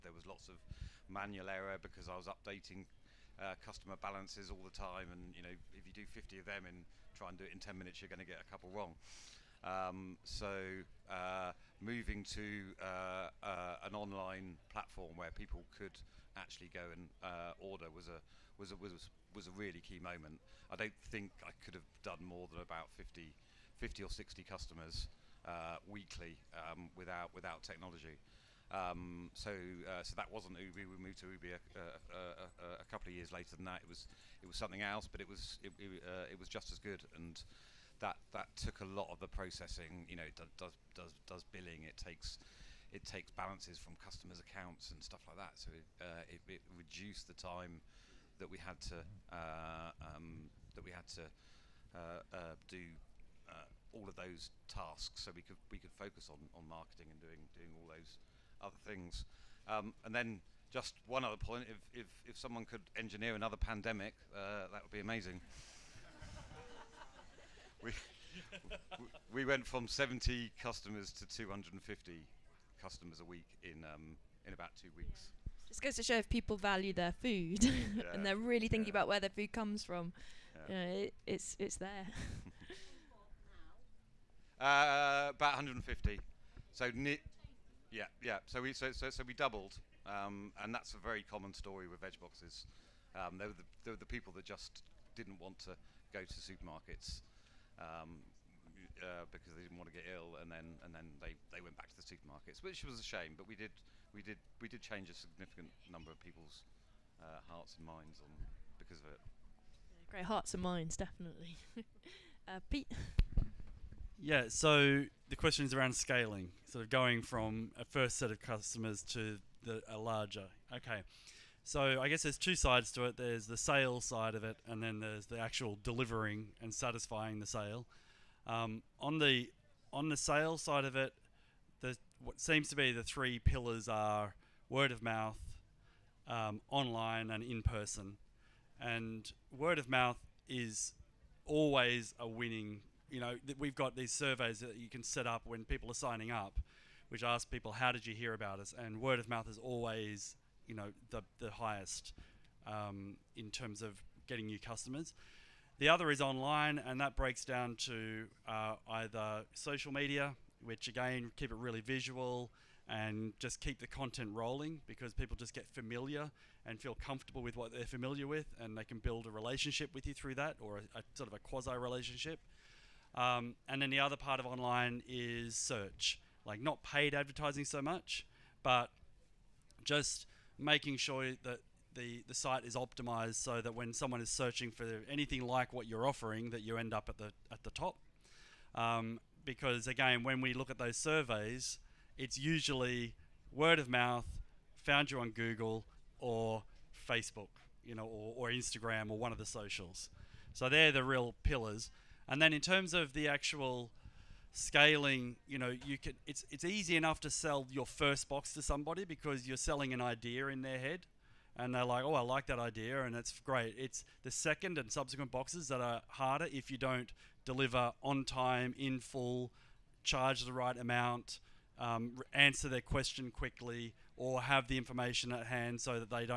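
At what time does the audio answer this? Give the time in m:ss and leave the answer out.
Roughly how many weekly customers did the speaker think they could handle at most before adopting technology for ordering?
0:23.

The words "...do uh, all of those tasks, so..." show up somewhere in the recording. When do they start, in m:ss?
0:52.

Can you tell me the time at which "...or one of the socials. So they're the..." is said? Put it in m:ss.
3:19.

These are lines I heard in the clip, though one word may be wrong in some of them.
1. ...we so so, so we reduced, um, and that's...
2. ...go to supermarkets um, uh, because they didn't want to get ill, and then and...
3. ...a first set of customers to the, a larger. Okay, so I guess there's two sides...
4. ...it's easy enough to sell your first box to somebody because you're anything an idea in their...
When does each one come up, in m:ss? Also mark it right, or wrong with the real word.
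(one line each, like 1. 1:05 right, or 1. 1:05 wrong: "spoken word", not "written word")
1. 1:28 wrong: "doubled", not "reduced"
2. 1:36 right
3. 1:57 right
4. 3:26 wrong: "selling", not "anything".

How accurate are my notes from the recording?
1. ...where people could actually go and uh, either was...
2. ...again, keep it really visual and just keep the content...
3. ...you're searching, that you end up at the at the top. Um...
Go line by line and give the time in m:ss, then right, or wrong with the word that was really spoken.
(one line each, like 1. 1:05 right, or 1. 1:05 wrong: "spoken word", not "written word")
1. 0:15 wrong: "order", not "either"
2. 2:40 right
3. 3:05 wrong: "offering", not "searching".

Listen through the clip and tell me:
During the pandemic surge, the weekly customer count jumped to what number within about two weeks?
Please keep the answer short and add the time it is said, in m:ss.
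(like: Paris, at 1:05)
250, at 1:11.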